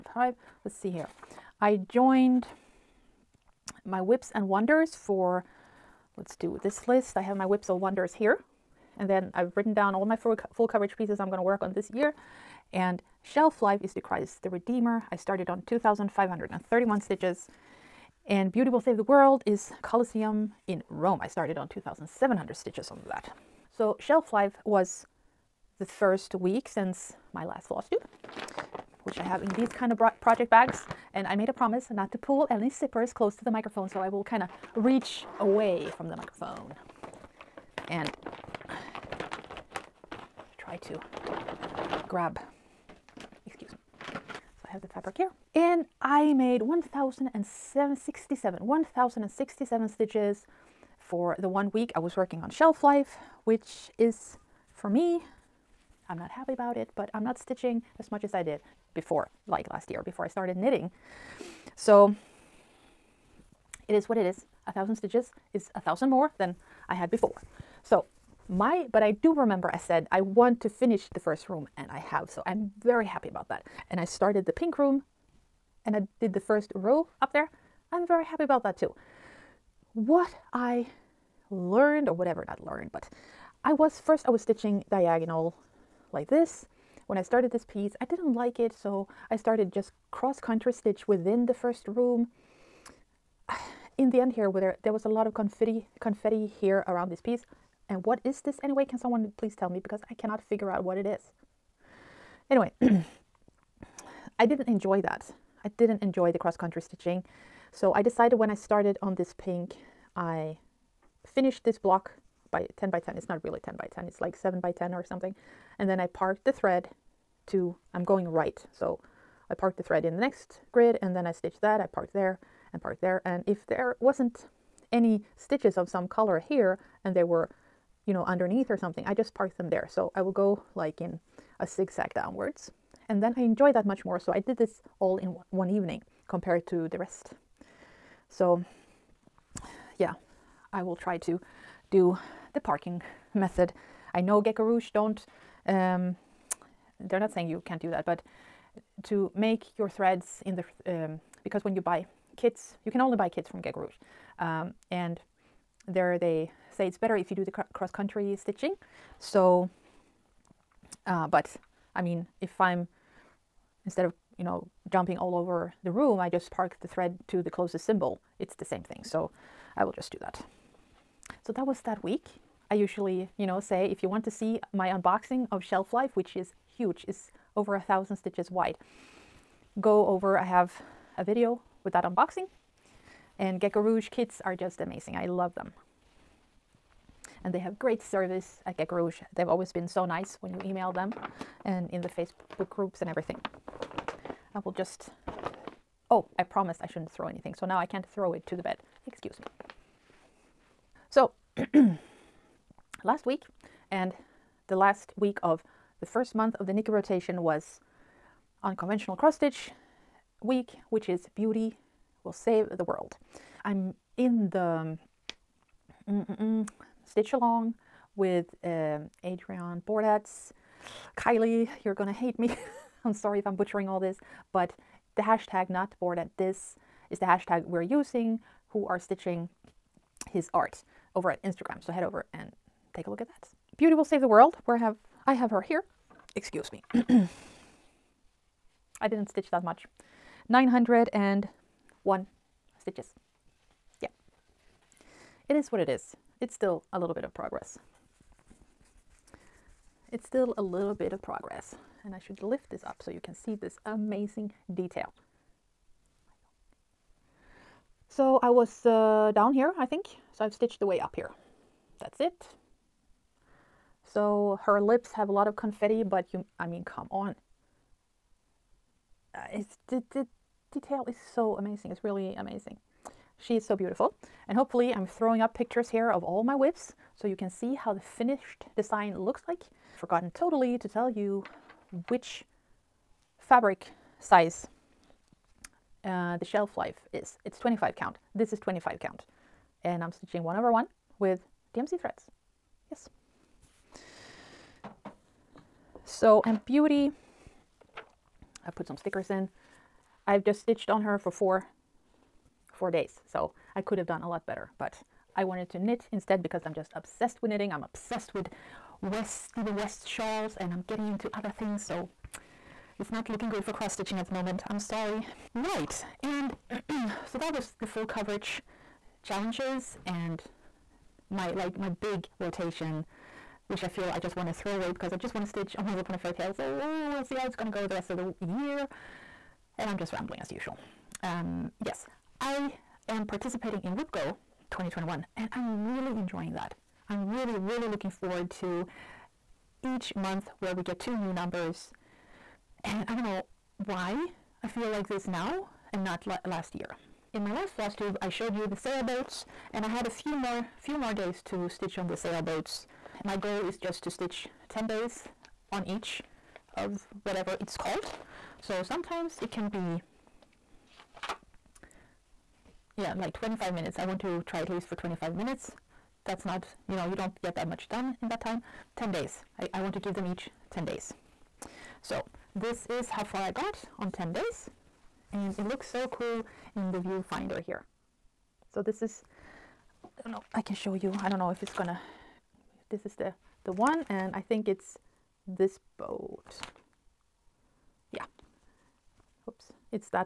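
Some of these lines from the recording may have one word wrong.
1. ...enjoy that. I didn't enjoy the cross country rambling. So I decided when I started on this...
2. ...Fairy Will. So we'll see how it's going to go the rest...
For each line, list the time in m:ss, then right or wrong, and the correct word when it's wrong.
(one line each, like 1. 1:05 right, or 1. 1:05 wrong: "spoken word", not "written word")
1. 1:44 wrong: "stitching", not "rambling"
2. 5:26 wrong: "Tale", not "Will".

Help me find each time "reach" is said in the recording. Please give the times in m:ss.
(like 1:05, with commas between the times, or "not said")
0:34.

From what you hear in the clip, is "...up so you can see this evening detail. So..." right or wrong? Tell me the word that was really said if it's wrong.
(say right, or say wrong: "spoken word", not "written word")
wrong: "amazing", not "evening".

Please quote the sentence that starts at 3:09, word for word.
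They've always been so nice when you email them and in the Facebook groups and everything.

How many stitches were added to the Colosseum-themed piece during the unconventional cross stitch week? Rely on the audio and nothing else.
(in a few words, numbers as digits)
901.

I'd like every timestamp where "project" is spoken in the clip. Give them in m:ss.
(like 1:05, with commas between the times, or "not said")
0:30.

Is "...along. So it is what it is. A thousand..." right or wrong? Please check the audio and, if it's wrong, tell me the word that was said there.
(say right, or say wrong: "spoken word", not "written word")
wrong: "knitting", not "along".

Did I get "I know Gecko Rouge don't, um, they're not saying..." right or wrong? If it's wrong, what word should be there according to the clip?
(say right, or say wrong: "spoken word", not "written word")
right.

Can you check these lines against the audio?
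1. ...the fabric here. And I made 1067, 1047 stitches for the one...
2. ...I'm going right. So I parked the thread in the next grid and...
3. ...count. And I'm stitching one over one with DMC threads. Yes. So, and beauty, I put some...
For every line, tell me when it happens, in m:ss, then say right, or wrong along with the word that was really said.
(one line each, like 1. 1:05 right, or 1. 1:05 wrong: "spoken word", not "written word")
1. 0:44 wrong: "1067", not "1047"
2. 1:57 right
3. 4:49 right.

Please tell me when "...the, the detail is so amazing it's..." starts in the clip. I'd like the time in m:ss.
4:29.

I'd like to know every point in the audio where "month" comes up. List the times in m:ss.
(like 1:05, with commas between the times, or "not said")
3:26, 5:40.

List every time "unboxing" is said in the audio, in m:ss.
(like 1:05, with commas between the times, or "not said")
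2:54, 3:02.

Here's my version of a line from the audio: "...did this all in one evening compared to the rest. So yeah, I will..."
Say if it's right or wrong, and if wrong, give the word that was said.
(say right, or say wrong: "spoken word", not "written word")
right.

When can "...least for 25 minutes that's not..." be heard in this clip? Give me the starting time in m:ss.
6:04.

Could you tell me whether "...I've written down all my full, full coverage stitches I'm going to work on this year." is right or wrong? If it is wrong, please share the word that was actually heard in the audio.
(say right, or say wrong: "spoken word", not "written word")
wrong: "pieces", not "stitches".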